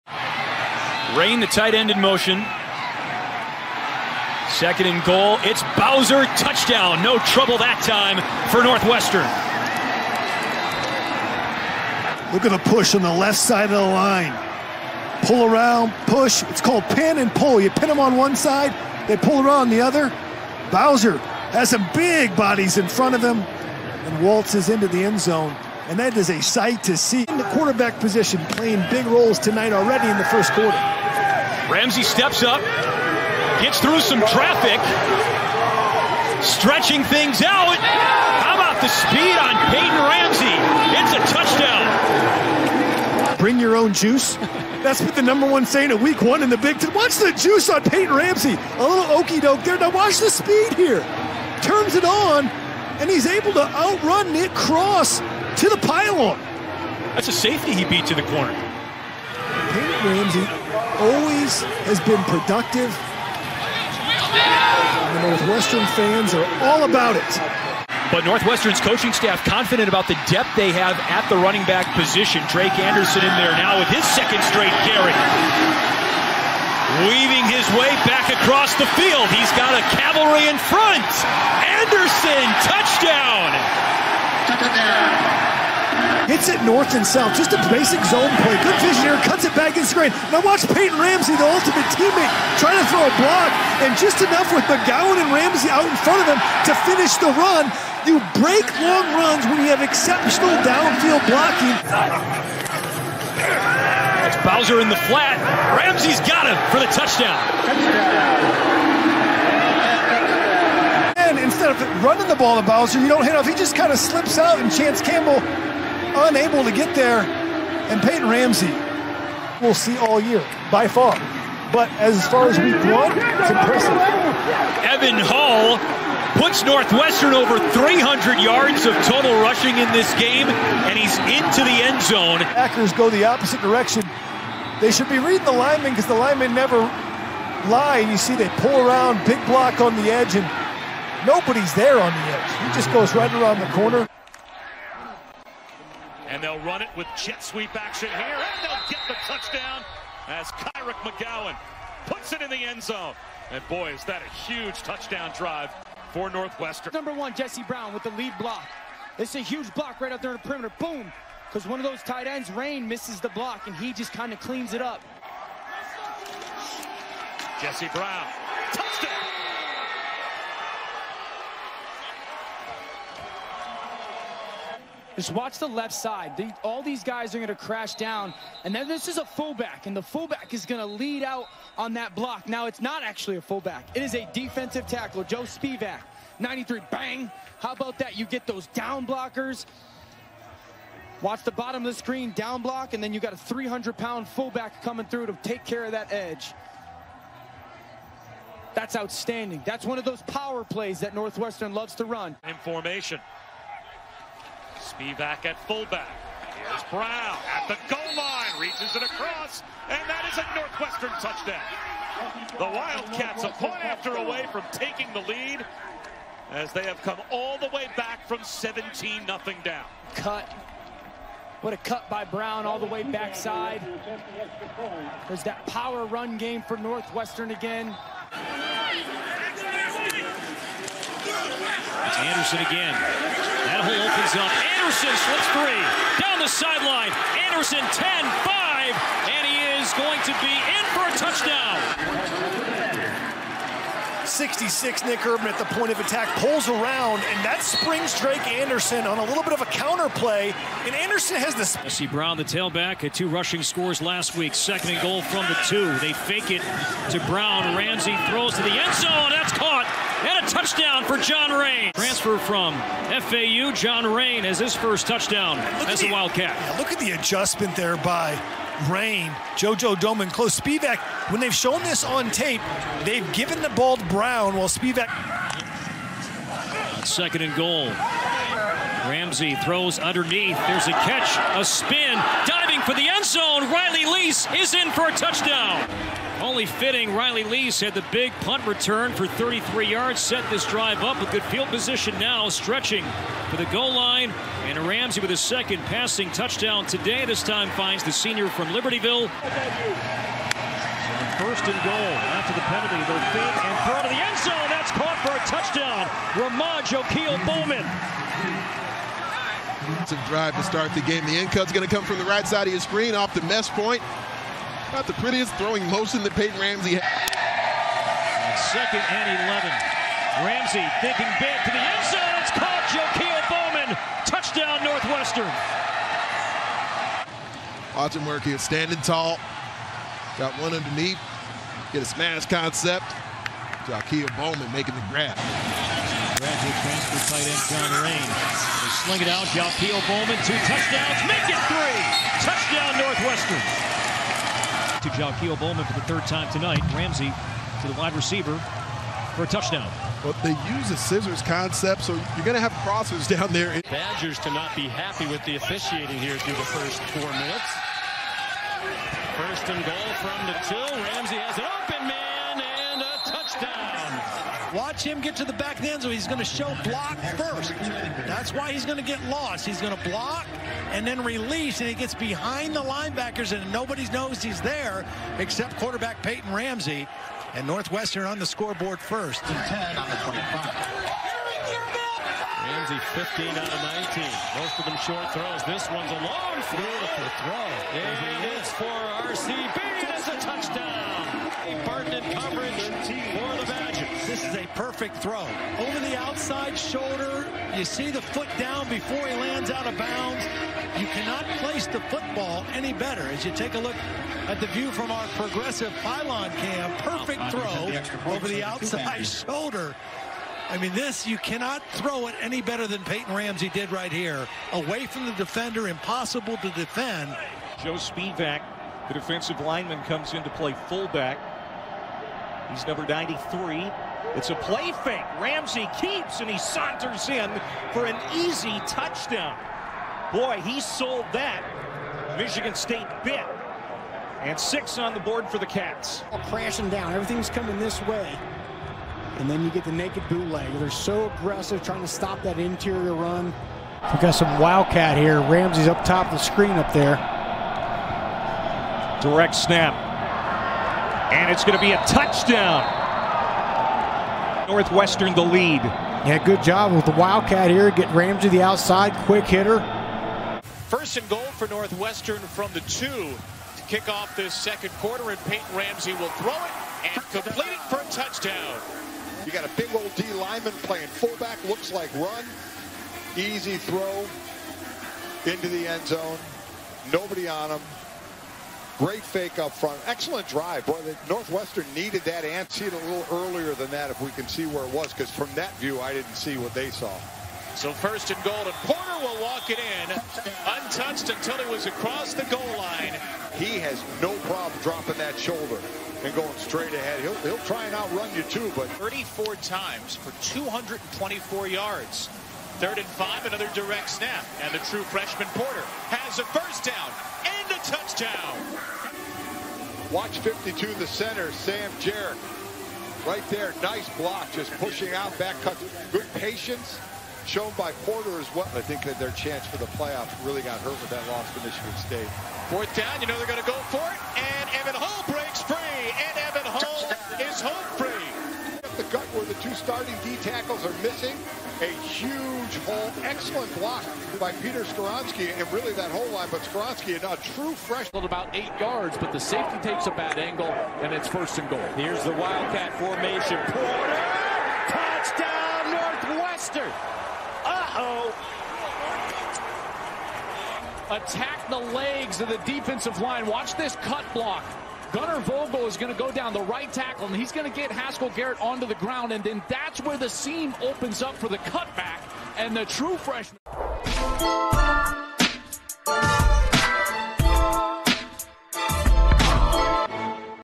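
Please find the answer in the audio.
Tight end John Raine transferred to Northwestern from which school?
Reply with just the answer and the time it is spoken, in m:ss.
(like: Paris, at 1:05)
FAU, at 4:23.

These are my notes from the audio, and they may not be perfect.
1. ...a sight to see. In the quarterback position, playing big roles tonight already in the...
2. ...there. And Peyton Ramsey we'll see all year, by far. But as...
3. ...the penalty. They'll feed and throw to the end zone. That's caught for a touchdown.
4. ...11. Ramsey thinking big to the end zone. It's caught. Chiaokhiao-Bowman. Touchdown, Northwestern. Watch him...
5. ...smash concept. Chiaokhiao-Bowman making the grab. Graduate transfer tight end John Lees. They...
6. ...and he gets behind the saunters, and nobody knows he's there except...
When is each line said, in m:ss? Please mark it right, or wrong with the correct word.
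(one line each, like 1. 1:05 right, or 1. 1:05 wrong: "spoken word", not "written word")
1. 0:26 right
2. 1:56 right
3. 5:02 right
4. 5:19 right
5. 5:32 wrong: "Raine", not "Lees"
6. 6:11 wrong: "linebackers", not "saunters".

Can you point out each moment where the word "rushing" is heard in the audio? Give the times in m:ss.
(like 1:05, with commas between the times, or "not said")
2:09, 4:13.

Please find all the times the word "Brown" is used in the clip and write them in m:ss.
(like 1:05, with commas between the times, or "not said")
2:37, 2:47, 3:26, 3:42, 4:12, 4:17, 4:34.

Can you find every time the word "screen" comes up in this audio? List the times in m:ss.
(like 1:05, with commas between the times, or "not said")
1:30, 3:11, 5:12, 7:26.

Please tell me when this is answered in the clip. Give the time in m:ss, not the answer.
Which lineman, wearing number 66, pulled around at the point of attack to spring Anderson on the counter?
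4:05.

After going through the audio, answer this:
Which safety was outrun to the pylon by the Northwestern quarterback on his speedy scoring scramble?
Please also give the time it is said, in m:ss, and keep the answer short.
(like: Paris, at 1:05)
Nick Cross, at 0:54.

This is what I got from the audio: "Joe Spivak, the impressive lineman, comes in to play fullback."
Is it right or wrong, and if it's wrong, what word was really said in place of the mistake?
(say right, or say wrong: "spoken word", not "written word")
wrong: "defensive", not "impressive".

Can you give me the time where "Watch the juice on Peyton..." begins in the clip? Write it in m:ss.
0:46.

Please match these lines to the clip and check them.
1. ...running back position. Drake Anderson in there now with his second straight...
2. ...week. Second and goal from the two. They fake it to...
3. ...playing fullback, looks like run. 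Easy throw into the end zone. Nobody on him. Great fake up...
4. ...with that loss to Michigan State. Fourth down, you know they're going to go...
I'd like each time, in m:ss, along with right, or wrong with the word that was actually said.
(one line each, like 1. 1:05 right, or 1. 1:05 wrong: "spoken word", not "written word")
1. 1:11 right
2. 4:14 right
3. 7:50 right
4. 8:41 right.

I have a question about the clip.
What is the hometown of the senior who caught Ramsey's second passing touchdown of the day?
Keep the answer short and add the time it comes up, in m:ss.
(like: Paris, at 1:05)
Libertyville, at 4:58.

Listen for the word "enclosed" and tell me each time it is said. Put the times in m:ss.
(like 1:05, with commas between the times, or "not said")
not said.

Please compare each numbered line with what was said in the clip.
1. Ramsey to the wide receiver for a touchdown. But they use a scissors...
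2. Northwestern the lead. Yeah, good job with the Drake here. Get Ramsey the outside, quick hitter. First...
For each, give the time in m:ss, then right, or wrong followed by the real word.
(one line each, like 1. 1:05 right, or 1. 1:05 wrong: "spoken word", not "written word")
1. 5:46 right
2. 7:34 wrong: "Wildcat", not "Drake".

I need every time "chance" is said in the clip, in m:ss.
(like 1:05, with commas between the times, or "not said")
1:54, 8:39.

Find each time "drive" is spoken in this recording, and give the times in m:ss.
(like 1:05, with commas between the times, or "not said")
2:35, 4:50, 5:10, 8:00.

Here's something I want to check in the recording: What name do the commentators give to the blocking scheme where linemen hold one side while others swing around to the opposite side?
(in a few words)
pin and pull.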